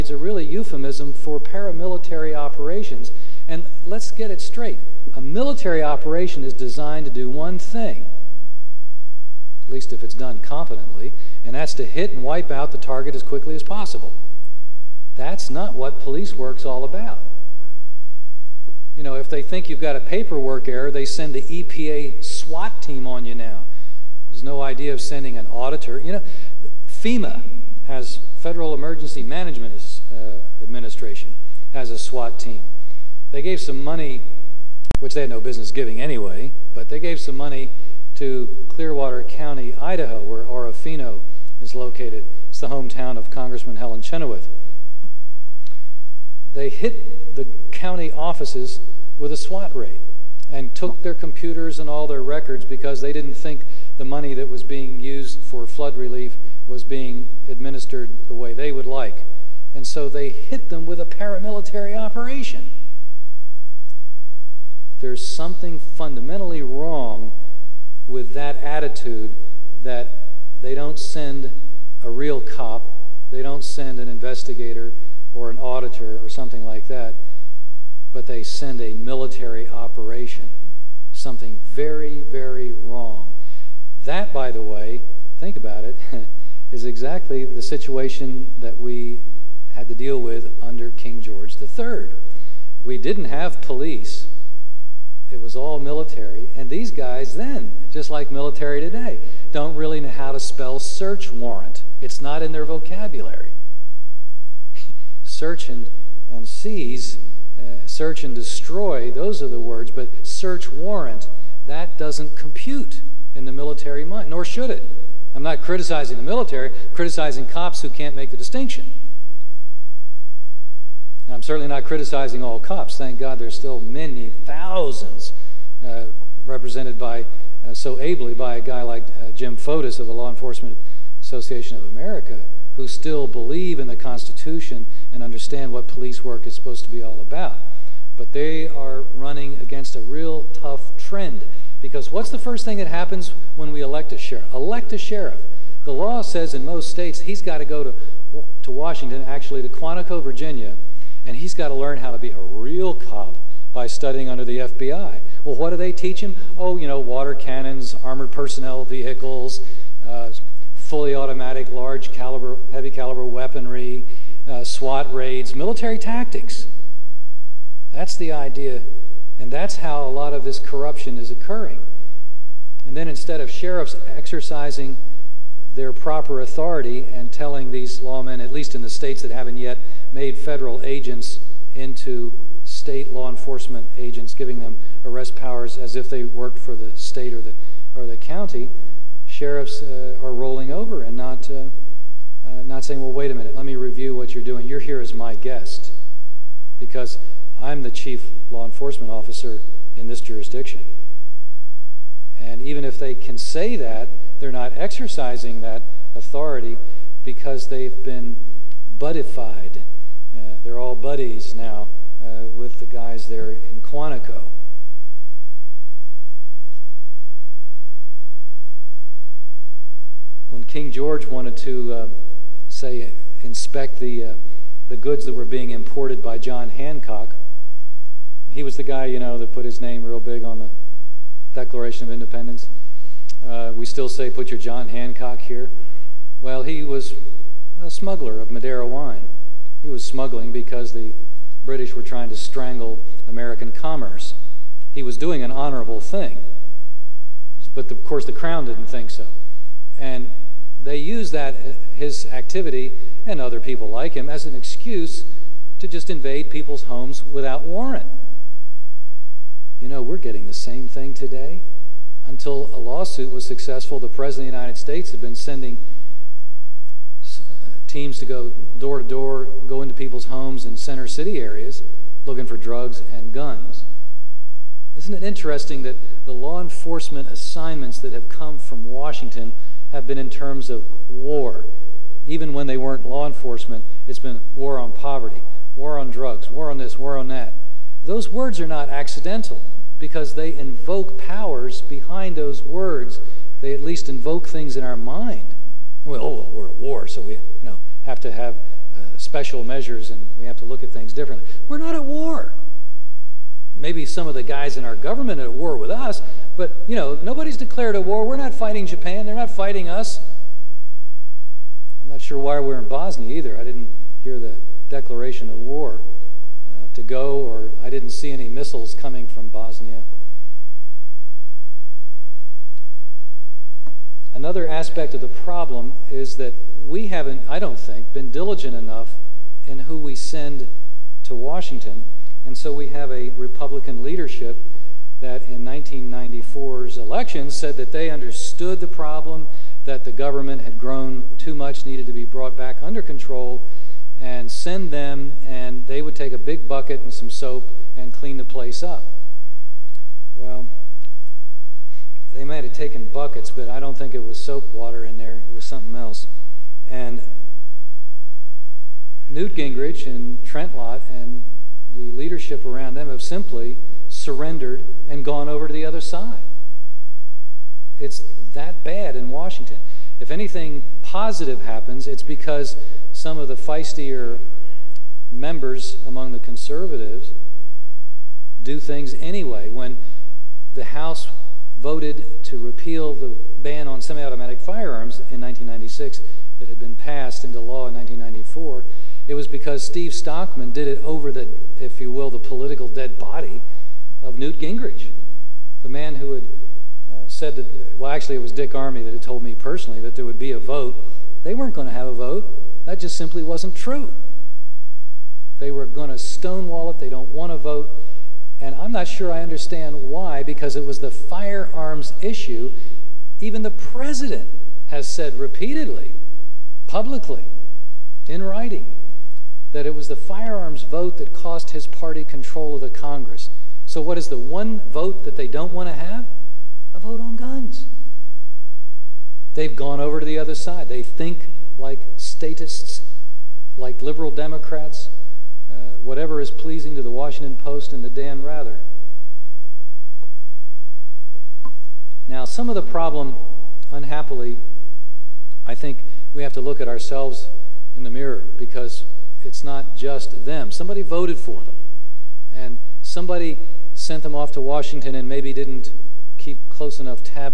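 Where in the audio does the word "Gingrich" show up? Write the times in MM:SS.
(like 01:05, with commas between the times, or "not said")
05:59, 06:34.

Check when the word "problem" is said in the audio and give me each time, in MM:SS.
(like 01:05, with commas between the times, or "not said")
05:25, 05:38, 07:22.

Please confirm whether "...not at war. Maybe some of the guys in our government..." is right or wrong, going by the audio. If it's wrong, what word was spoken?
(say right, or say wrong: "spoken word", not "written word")
right.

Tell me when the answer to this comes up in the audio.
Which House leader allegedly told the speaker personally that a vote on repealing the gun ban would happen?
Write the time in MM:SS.
06:38.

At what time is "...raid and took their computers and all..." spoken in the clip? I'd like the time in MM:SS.
00:49.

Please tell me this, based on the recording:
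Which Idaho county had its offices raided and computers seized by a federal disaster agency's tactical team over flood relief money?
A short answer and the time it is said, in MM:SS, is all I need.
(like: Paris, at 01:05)
Clearwater County, at 00:38.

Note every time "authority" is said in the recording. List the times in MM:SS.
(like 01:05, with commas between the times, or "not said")
02:56, 03:26.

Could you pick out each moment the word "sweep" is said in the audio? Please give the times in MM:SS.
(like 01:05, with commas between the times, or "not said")
not said.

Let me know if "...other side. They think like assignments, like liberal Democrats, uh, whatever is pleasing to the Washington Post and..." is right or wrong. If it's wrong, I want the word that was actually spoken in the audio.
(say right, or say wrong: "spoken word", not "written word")
wrong: "statists", not "assignments".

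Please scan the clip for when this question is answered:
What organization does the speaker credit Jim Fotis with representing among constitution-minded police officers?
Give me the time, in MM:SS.
02:10.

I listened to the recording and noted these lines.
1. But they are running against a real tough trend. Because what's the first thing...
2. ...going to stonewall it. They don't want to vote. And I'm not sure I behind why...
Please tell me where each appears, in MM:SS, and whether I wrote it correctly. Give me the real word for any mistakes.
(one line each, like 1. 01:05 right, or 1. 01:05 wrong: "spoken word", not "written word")
1. 02:18 right
2. 06:45 wrong: "understand", not "behind".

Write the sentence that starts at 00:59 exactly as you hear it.
And so they hit them with a paramilitary operation.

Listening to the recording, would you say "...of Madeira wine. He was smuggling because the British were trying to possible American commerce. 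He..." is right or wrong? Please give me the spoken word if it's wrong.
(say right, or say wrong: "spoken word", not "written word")
wrong: "strangle", not "possible".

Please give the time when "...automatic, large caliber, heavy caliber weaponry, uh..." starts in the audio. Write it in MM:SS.
02:41.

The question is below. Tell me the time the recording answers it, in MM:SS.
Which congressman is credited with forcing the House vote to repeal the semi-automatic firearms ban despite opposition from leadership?
06:29.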